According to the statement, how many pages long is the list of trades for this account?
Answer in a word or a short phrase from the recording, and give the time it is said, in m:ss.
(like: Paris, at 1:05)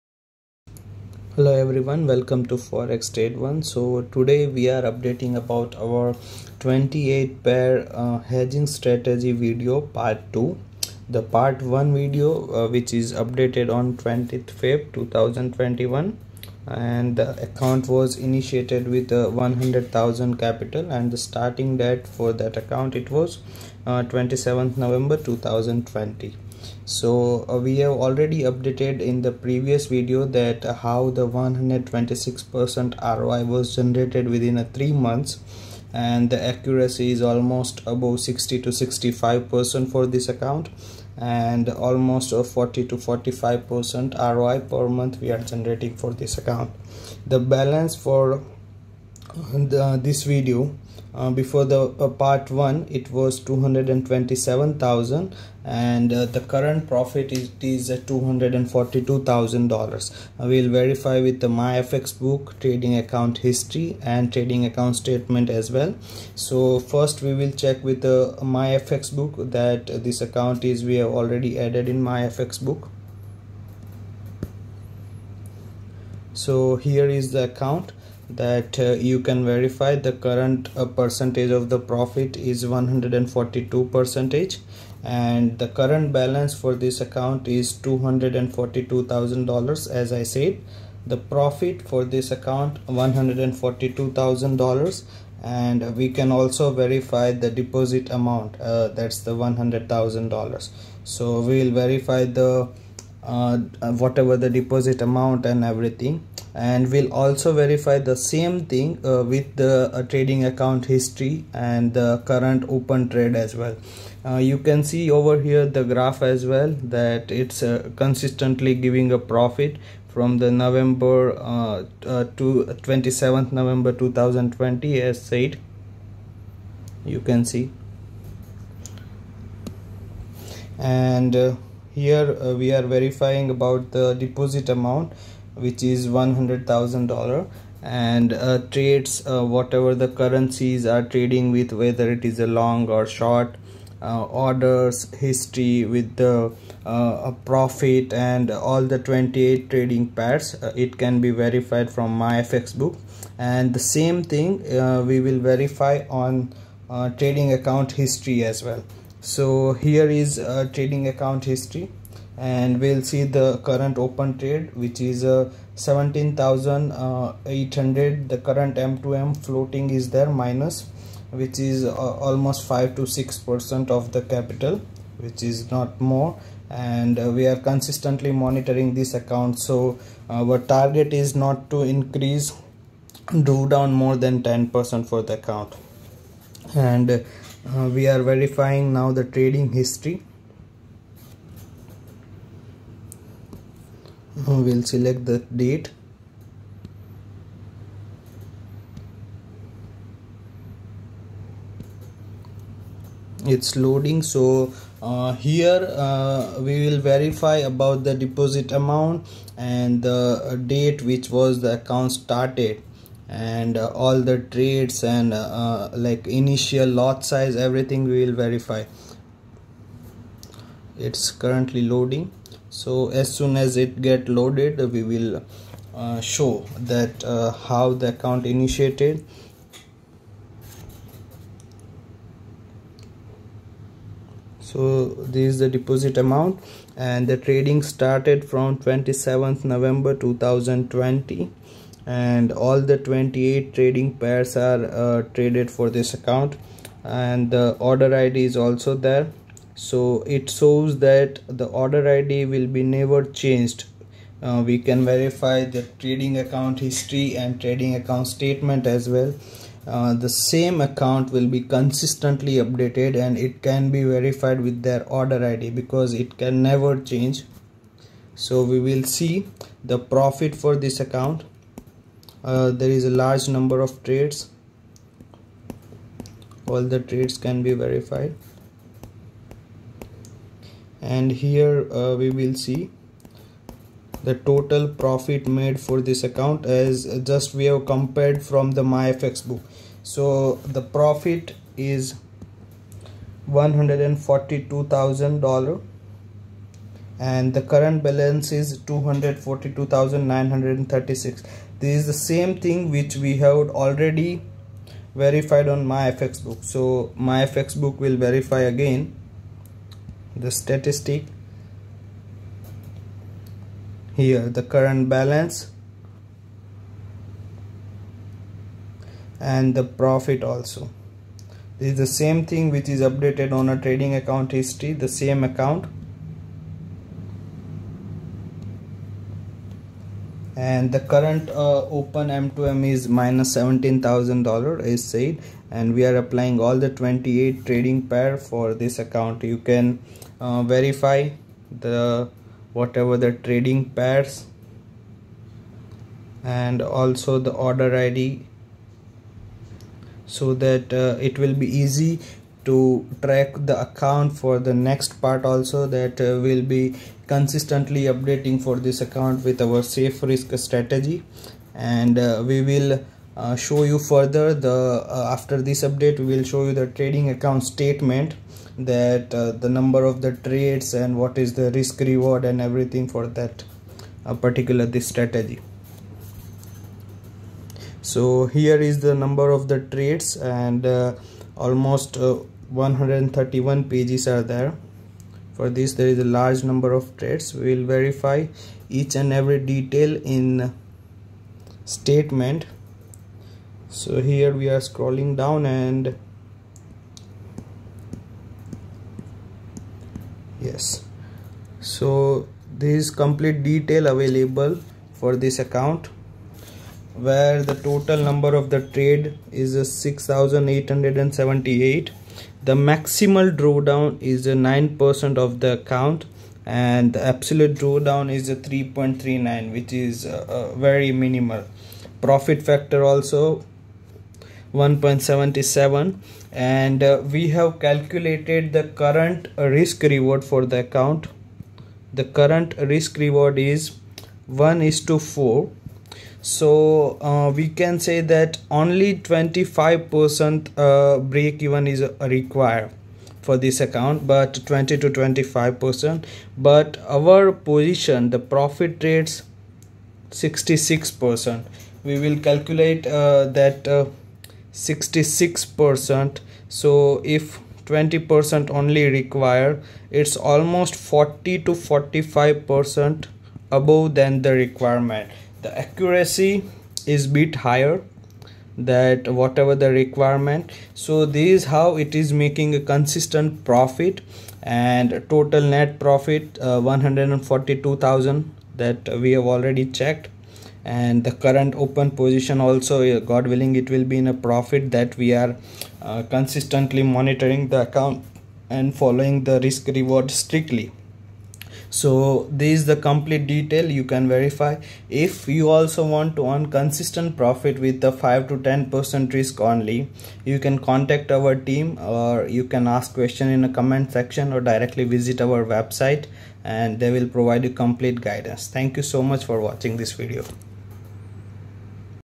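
131, at 6:22.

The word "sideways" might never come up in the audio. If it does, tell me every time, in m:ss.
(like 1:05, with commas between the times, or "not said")
not said.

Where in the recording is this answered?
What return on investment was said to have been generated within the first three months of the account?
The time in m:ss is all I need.
0:31.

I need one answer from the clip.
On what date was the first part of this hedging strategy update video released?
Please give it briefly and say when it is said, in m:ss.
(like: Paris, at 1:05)
20th Feb 2021, at 0:13.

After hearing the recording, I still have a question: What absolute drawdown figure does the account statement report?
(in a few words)
3.39.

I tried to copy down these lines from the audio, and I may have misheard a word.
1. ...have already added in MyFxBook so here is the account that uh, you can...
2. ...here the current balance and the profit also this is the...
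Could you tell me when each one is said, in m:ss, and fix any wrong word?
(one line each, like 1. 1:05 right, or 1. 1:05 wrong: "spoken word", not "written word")
1. 1:10 right
2. 5:14 right.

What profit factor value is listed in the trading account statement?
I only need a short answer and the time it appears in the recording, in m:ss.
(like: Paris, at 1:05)
1.77, at 7:04.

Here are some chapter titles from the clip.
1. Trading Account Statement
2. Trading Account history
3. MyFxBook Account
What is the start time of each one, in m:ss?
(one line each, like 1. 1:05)
1. 6:10
2. 2:40
3. 1:10.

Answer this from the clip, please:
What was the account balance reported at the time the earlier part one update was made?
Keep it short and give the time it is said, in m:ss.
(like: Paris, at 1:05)
227000, at 0:53.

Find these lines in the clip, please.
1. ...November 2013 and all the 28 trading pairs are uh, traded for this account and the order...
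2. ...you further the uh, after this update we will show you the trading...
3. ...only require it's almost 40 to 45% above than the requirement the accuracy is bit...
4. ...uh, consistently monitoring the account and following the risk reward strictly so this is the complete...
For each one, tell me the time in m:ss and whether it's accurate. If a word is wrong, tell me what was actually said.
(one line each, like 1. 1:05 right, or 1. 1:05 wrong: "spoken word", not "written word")
1. 3:59 wrong: "2020", not "2013"
2. 6:03 right
3. 7:38 right
4. 8:06 right.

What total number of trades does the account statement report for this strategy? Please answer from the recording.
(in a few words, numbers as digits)
6878.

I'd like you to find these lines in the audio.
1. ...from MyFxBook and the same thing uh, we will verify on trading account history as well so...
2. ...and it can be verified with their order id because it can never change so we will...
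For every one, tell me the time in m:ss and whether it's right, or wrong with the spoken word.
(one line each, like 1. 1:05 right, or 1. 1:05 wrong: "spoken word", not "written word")
1. 2:31 right
2. 4:23 right.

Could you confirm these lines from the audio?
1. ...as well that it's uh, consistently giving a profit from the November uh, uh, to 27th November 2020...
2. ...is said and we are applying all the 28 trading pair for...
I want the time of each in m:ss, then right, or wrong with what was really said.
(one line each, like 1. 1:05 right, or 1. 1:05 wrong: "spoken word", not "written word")
1. 1:56 right
2. 5:34 right.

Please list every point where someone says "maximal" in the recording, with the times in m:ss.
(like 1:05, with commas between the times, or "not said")
6:52.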